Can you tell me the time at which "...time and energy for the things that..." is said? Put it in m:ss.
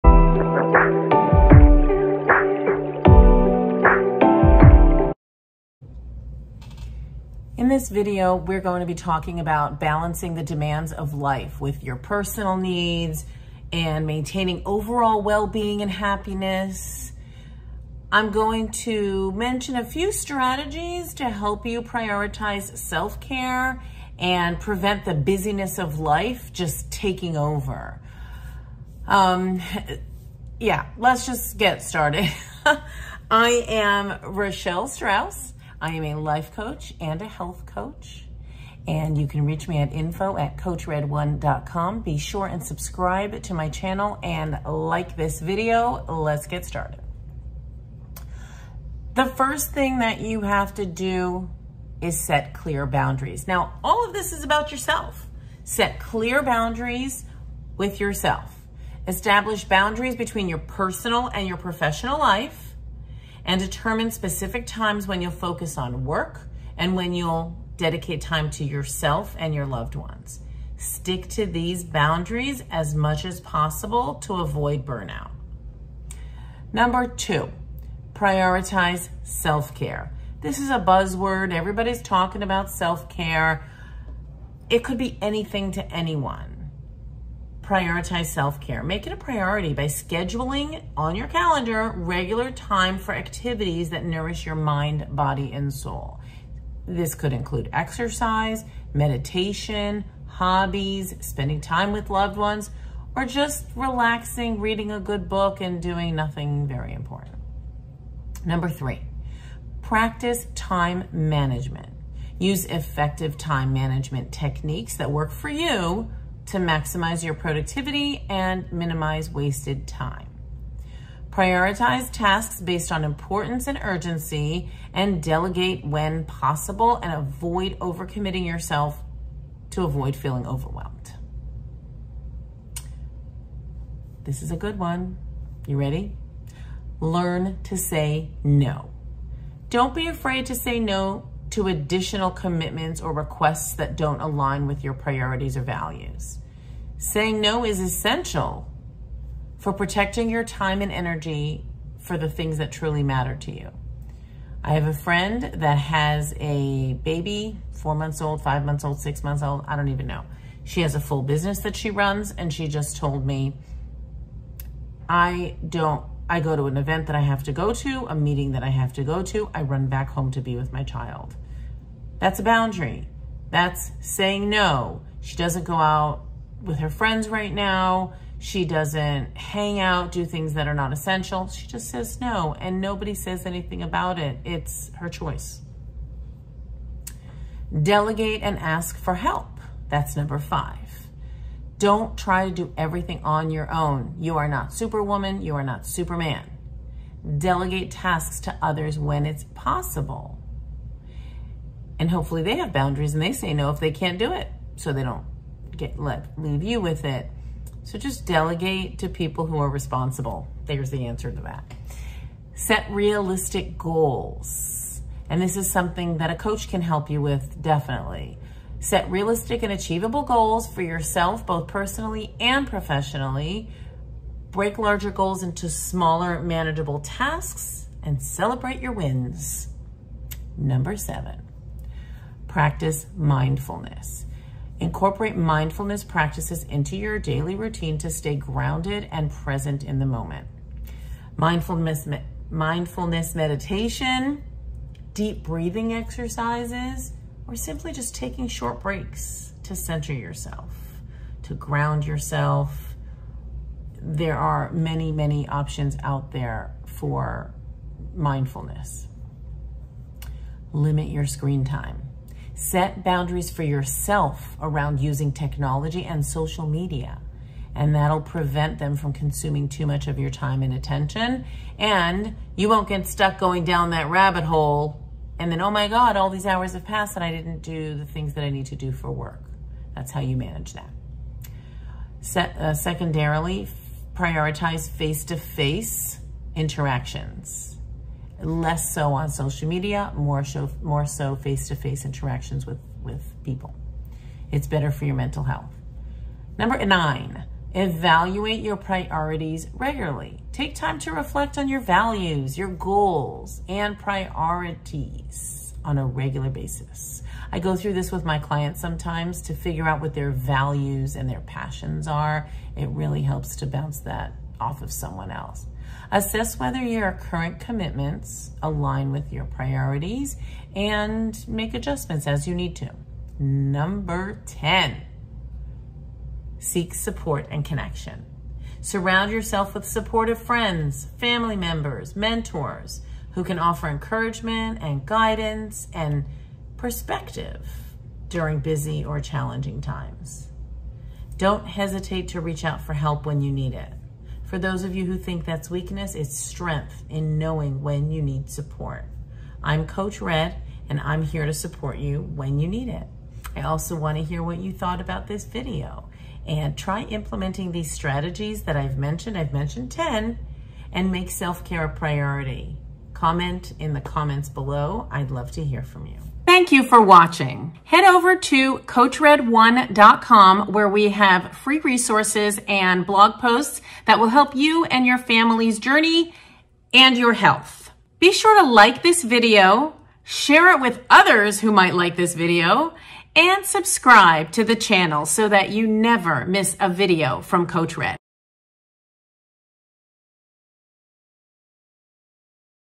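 2:30.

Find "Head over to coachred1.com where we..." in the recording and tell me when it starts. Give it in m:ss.
6:07.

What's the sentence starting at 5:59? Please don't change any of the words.
I've mentioned 10 and make self-care a priority.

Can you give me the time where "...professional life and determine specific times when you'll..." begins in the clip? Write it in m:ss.
1:01.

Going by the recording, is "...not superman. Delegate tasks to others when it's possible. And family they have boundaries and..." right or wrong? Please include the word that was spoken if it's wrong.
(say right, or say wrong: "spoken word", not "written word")
wrong: "hopefully", not "family".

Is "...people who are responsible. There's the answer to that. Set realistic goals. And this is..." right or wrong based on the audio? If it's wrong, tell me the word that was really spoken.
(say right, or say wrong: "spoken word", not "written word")
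right.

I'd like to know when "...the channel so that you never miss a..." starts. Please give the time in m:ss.
6:24.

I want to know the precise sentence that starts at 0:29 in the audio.
Um, yeah, let's just get started.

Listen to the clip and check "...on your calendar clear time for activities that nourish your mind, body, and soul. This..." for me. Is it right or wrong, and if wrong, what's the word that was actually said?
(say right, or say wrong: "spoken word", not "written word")
wrong: "regular", not "clear".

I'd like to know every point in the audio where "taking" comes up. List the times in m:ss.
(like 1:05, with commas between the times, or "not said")
0:26, 4:08.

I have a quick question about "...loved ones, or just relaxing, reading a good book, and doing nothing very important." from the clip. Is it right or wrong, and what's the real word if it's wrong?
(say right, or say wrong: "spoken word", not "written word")
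right.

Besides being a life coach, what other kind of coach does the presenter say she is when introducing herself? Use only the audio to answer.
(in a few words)
health coach.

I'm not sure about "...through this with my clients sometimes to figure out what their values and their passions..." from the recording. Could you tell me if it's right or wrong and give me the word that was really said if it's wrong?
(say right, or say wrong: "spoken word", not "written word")
right.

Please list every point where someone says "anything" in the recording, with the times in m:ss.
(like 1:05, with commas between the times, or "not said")
1:25, 3:03.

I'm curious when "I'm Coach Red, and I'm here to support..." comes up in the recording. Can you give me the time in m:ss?
5:49.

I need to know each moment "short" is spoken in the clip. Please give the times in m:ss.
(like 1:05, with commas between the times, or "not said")
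4:08.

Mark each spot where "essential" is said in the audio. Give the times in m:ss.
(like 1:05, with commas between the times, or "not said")
2:27, 3:00.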